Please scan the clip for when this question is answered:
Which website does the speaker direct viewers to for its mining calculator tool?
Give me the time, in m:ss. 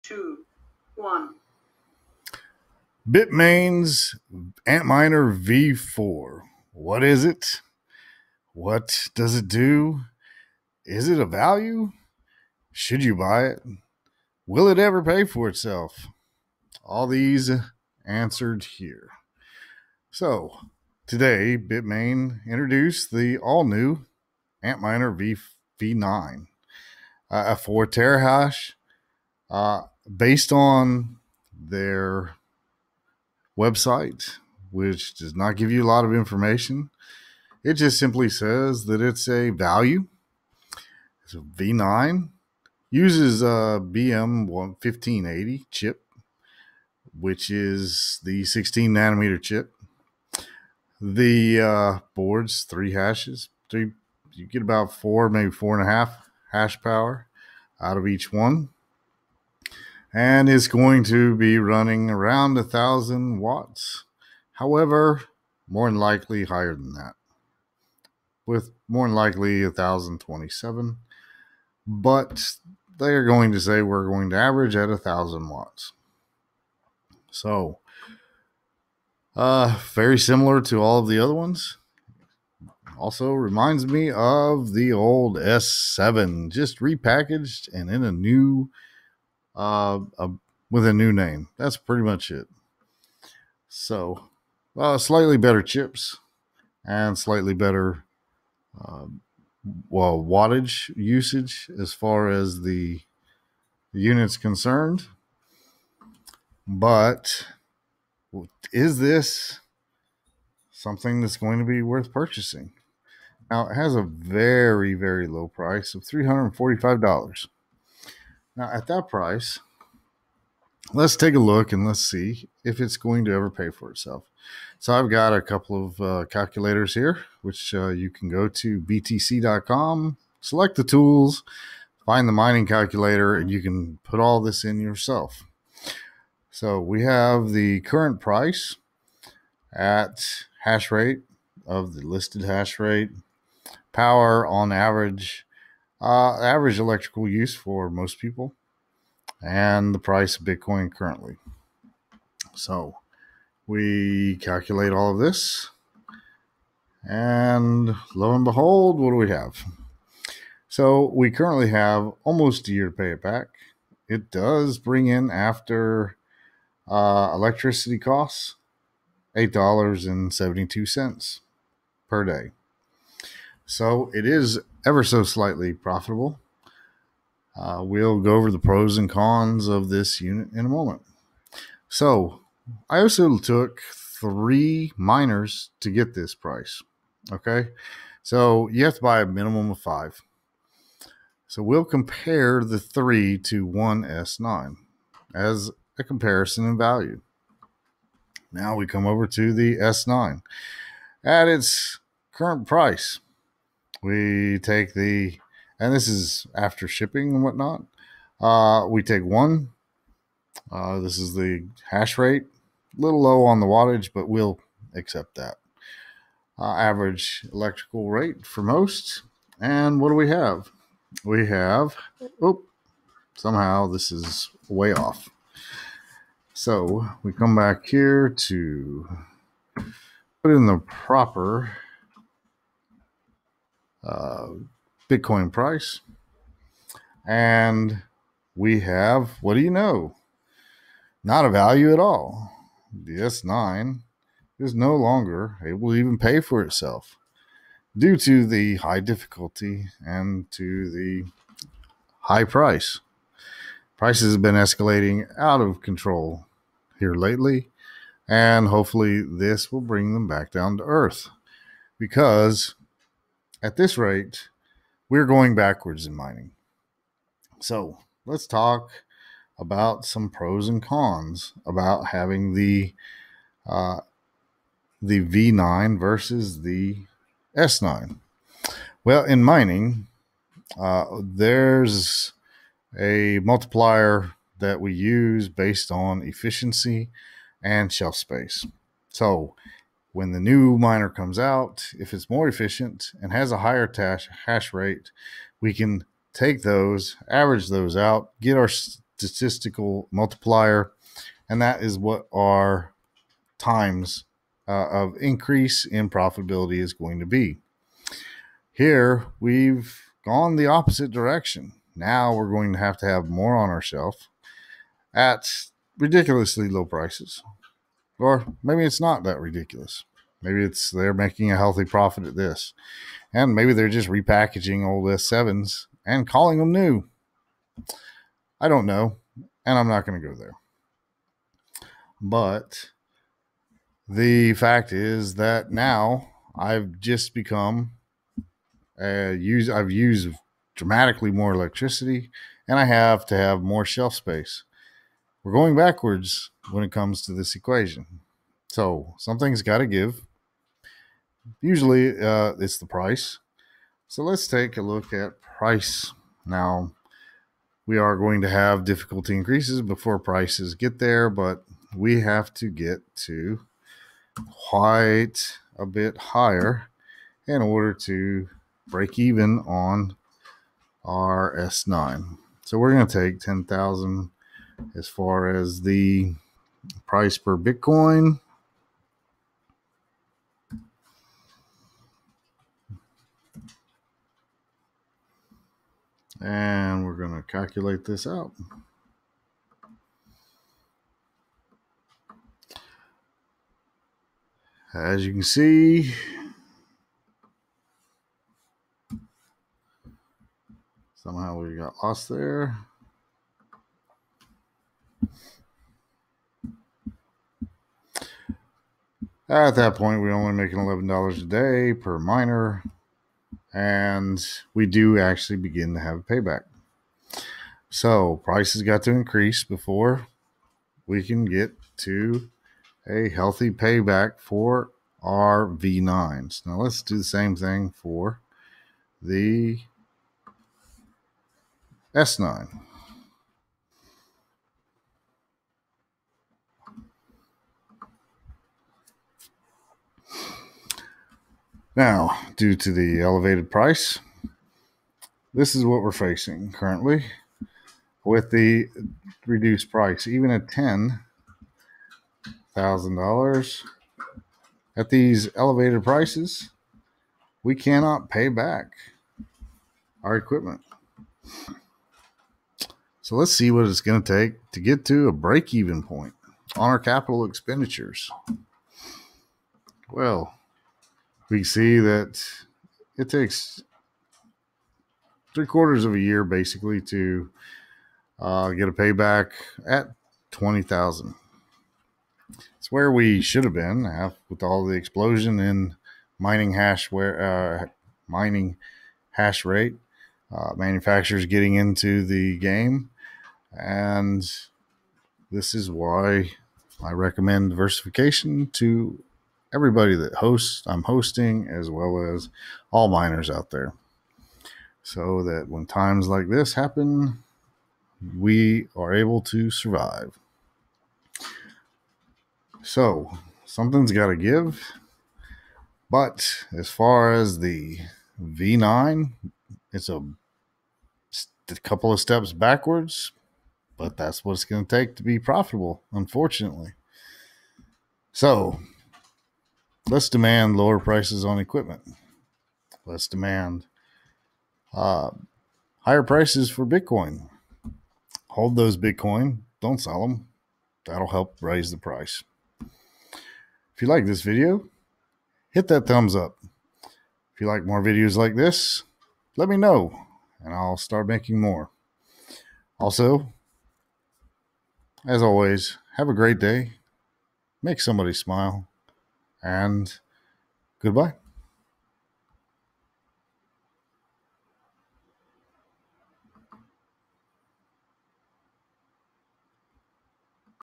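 2:08.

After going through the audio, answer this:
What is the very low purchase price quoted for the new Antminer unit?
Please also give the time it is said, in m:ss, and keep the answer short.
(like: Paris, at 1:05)
$345, at 1:56.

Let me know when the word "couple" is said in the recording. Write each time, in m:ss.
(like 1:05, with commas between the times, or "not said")
2:05, 8:41.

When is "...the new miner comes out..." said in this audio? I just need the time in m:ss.
4:50.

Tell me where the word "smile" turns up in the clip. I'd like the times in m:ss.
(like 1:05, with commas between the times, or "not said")
9:18.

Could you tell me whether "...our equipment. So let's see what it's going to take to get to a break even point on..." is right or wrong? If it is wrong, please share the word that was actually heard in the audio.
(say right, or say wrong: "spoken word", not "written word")
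right.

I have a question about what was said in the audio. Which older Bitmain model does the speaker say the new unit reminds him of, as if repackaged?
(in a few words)
S7.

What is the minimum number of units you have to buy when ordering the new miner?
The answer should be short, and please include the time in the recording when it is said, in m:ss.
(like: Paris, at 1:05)
5, at 3:09.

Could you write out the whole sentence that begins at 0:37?
It just simply says that it's a value.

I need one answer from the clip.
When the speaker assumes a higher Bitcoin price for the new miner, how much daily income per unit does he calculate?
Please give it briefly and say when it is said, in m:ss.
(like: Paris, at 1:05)
$11, at 6:50.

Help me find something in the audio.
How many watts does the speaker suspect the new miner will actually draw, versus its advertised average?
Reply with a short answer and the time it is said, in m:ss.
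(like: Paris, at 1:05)
1027, at 1:09.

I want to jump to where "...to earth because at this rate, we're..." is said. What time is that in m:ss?
4:20.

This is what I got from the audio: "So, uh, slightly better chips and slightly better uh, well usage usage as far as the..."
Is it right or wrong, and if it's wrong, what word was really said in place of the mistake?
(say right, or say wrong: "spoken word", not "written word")
wrong: "wattage", not "usage".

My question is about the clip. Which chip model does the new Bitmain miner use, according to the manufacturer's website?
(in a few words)
BM 1580.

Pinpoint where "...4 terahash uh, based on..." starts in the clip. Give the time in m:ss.
0:27.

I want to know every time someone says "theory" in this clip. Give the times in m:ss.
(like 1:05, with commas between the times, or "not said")
not said.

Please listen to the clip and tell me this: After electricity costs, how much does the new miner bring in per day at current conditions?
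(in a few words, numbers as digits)
$8.72.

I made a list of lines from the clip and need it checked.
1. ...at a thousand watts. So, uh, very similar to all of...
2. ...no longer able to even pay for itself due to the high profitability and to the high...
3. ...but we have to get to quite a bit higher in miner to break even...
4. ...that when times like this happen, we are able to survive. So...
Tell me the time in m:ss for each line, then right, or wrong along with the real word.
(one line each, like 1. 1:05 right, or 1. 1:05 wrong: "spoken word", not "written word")
1. 1:14 right
2. 4:04 wrong: "difficulty", not "profitability"
3. 6:01 wrong: "order", not "miner"
4. 8:25 right.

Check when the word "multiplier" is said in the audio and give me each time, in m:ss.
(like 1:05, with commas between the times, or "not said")
4:43, 5:00.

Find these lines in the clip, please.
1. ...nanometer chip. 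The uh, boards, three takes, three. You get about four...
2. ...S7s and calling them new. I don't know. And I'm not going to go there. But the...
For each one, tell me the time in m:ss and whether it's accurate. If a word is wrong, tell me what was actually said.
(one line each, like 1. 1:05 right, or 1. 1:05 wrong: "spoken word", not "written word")
1. 0:48 wrong: "hashes", not "takes"
2. 5:25 right.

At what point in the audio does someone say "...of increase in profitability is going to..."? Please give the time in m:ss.
5:04.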